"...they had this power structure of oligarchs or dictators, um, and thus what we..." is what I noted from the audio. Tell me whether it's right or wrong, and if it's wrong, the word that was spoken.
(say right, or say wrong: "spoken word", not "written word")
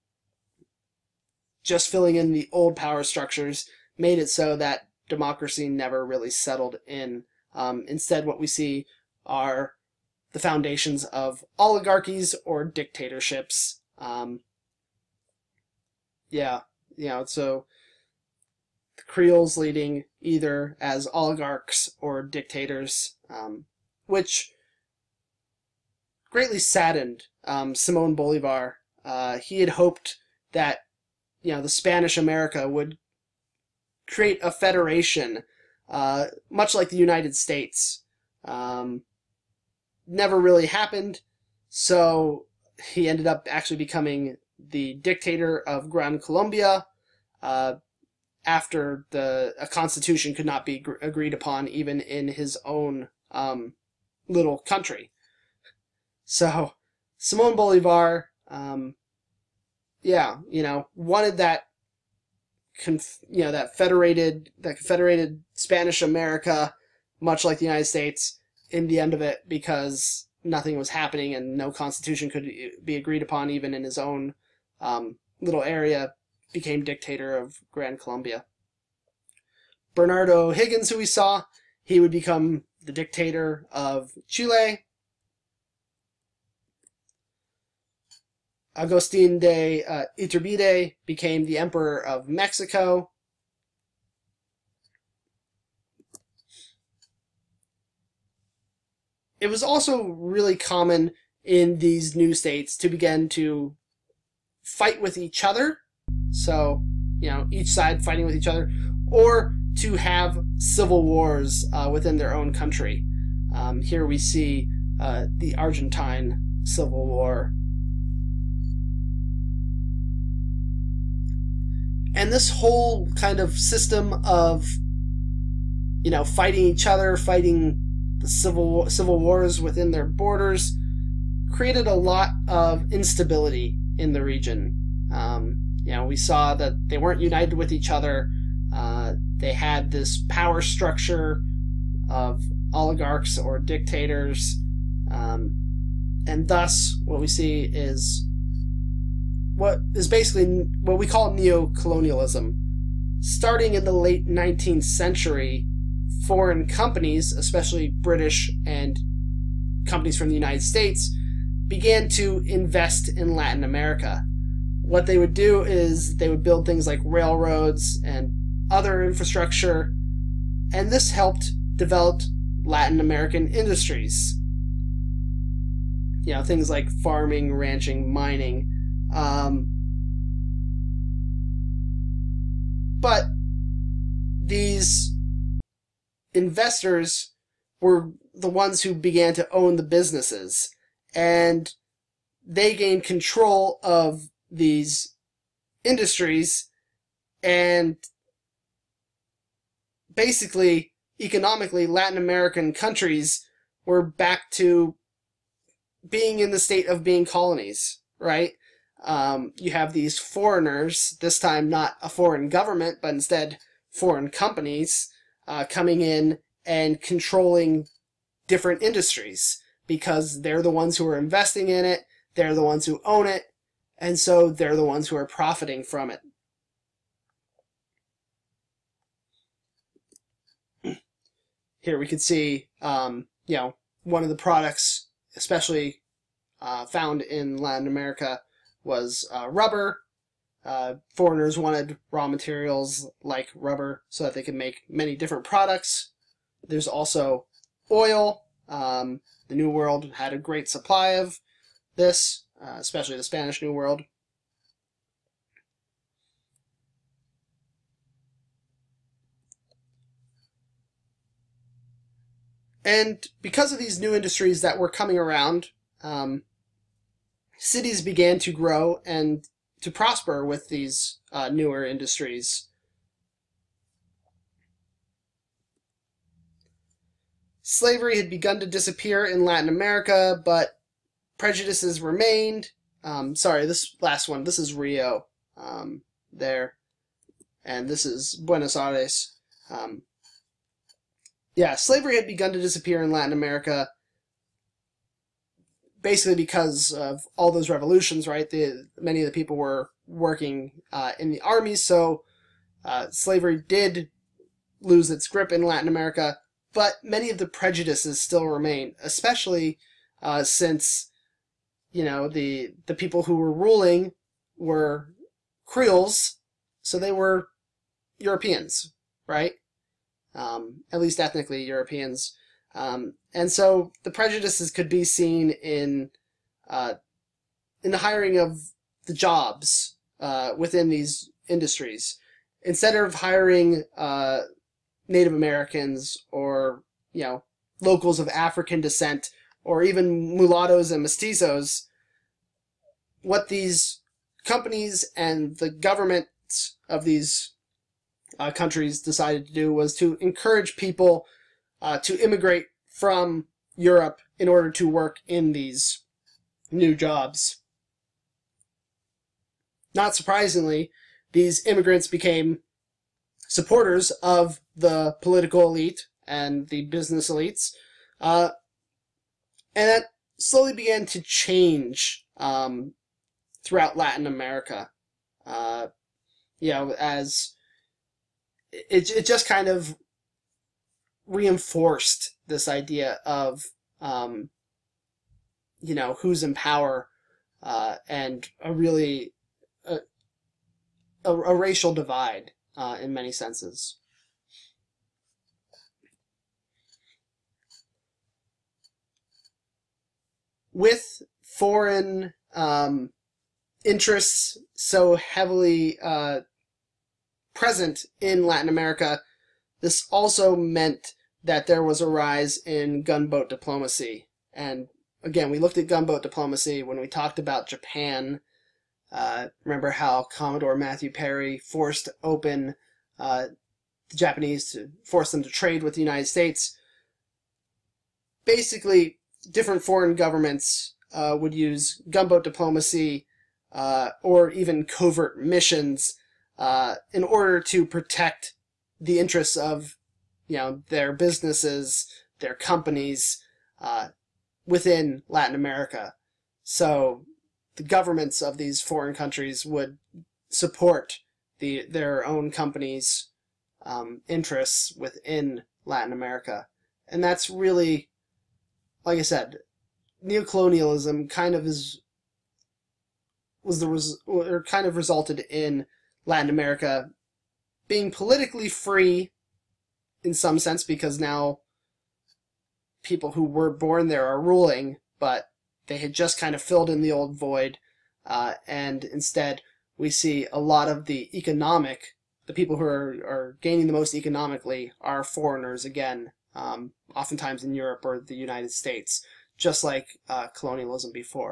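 right.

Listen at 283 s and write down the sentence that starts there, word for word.
Um, sorry, this last one, this is Rio um, there, and this is Buenos Aires.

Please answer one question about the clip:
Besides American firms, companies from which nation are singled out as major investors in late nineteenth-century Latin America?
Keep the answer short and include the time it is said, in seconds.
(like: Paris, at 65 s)
British, at 158 s.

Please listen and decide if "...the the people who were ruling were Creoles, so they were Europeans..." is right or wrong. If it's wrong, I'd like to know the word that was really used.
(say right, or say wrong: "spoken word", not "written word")
right.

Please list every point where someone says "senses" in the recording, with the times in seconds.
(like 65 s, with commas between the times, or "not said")
393 s, 470 s.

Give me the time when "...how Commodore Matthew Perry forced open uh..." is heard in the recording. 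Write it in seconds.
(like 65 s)
419 s.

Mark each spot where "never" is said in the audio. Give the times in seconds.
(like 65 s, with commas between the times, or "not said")
5 s, 40 s.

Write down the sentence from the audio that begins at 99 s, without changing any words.
It was also really common in these new states to begin to fight with each other.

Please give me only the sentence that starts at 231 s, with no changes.
Here we can see, um, you know, one of the products, especially uh, found in Latin America, was uh, rubber.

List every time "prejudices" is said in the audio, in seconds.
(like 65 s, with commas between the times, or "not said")
281 s, 307 s, 324 s.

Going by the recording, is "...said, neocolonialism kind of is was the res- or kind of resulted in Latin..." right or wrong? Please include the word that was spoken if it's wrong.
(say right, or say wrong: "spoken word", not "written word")
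right.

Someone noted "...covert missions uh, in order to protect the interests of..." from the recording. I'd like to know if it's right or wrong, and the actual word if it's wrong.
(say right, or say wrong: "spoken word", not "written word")
right.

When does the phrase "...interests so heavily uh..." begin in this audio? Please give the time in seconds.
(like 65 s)
403 s.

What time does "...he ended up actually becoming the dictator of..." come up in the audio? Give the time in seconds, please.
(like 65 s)
42 s.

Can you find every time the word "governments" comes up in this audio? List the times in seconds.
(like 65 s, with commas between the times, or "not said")
212 s, 345 s, 430 s, 447 s.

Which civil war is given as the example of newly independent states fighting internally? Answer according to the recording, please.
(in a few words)
Argentine Civil War.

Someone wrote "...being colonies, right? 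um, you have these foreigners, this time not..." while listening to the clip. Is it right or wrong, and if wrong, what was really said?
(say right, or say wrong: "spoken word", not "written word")
right.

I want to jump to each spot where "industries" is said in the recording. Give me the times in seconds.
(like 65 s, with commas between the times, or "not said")
173 s, 195 s, 218 s, 264 s, 271 s, 331 s.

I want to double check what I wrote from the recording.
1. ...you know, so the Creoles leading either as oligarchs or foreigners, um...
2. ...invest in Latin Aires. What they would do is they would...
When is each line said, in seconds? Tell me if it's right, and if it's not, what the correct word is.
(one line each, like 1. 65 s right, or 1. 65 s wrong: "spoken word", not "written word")
1. 16 s wrong: "dictators", not "foreigners"
2. 162 s wrong: "America", not "Aires".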